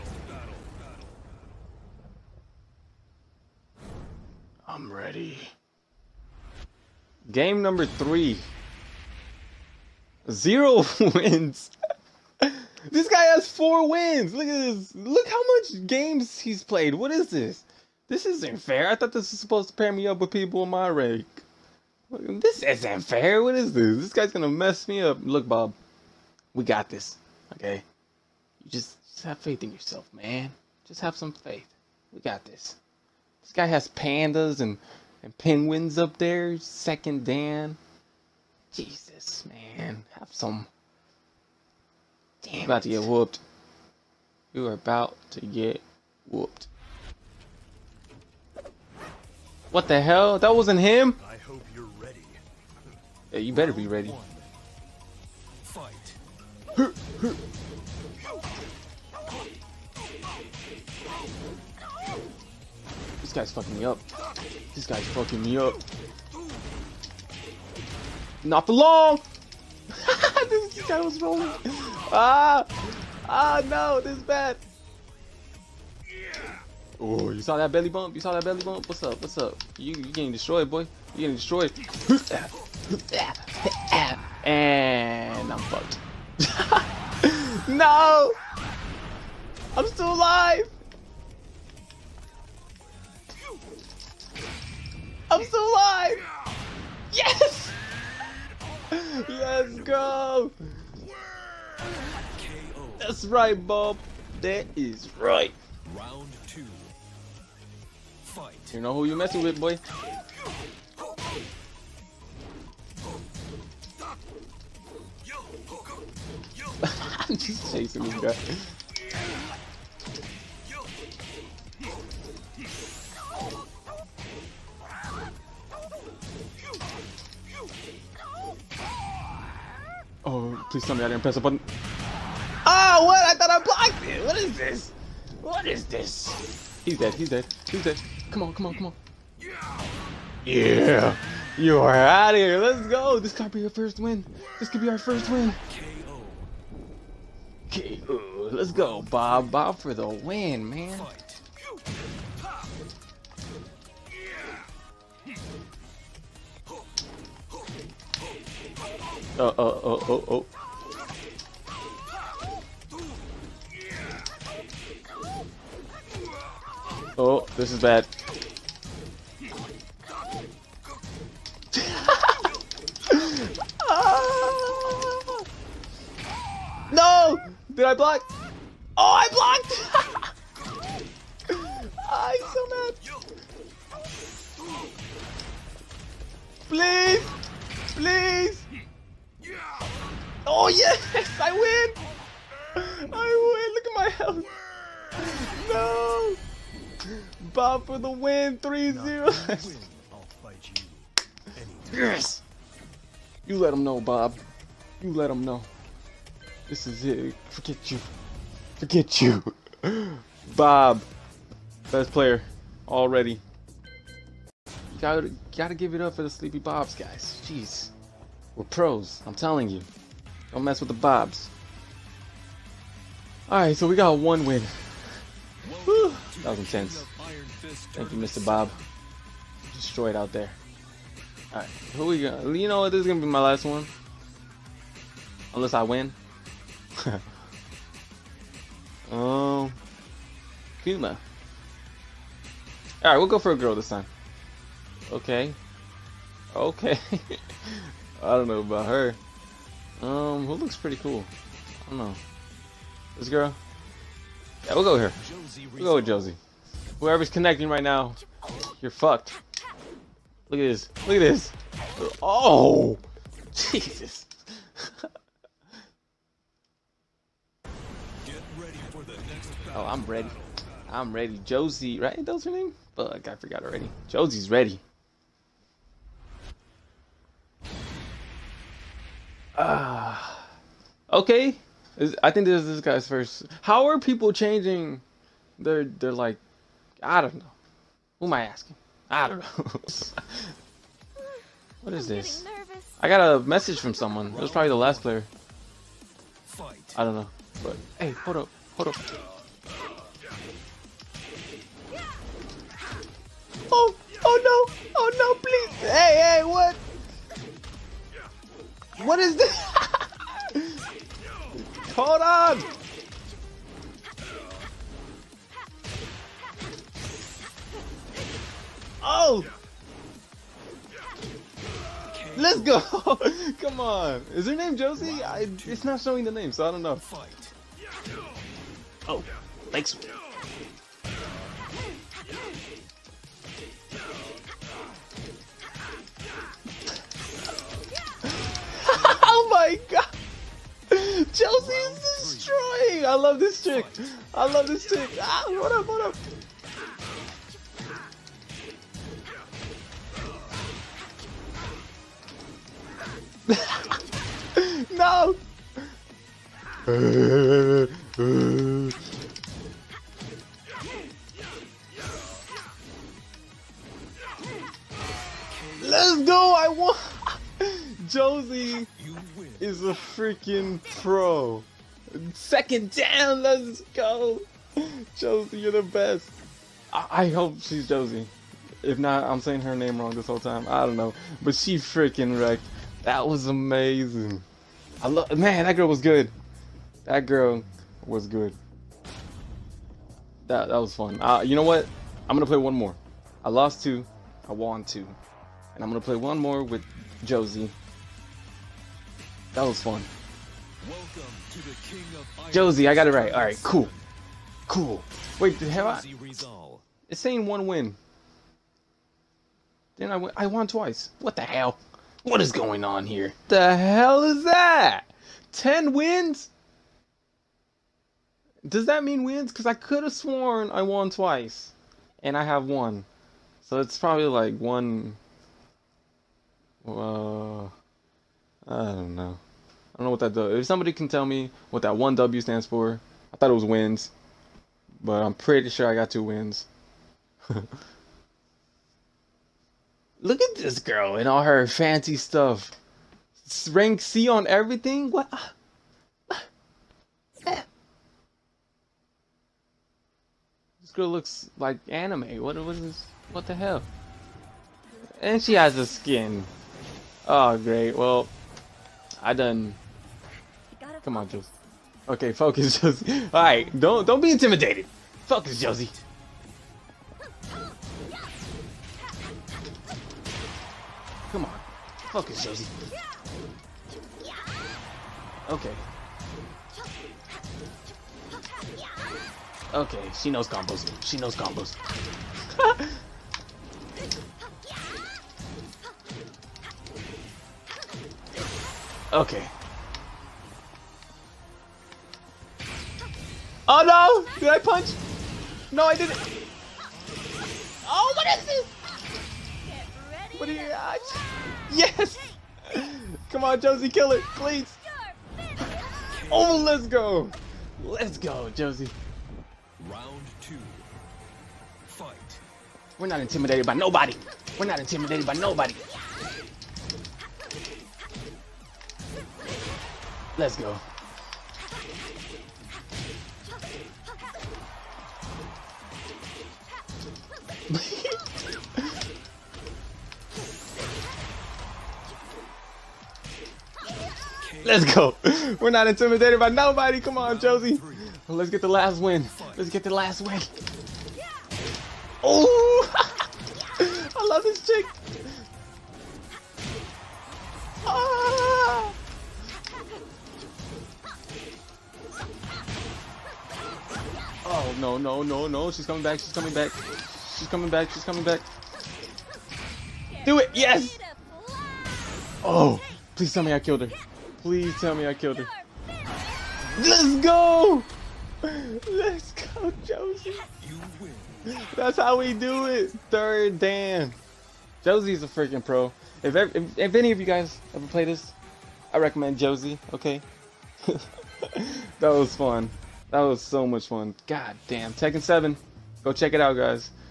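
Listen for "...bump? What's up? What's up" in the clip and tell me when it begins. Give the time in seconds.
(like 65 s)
78 s.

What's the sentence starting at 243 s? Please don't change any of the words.
All right, we'll go for a girl this time.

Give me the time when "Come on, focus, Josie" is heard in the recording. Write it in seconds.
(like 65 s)
471 s.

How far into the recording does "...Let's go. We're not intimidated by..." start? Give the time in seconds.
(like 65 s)
534 s.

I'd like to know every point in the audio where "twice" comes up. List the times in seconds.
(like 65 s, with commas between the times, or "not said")
410 s, 421 s.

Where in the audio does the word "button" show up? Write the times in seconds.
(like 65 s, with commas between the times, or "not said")
131 s.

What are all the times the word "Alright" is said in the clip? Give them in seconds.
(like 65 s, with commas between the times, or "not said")
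223 s, 231 s.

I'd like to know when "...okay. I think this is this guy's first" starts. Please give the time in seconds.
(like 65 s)
281 s.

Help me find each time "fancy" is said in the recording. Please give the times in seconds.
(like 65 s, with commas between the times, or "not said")
441 s.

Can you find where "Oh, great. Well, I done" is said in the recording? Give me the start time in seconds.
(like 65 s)
457 s.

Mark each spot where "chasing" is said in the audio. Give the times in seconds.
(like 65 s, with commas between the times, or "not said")
117 s.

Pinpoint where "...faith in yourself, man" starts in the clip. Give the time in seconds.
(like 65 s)
29 s.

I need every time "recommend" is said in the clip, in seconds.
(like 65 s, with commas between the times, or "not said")
578 s.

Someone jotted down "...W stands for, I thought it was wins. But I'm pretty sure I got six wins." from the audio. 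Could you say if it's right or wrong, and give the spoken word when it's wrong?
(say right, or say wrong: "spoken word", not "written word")
wrong: "two", not "six".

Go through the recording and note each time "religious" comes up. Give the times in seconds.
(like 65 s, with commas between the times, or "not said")
not said.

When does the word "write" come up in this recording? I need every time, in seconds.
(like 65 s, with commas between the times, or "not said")
not said.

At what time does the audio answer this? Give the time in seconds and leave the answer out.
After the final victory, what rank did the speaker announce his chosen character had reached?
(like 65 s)
573 s.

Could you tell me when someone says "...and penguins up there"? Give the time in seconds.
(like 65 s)
35 s.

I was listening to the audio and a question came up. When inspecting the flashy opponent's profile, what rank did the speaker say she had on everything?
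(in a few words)
Rank C.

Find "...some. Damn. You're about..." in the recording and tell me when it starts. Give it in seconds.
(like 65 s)
40 s.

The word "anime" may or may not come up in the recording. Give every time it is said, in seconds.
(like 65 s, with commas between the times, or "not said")
451 s.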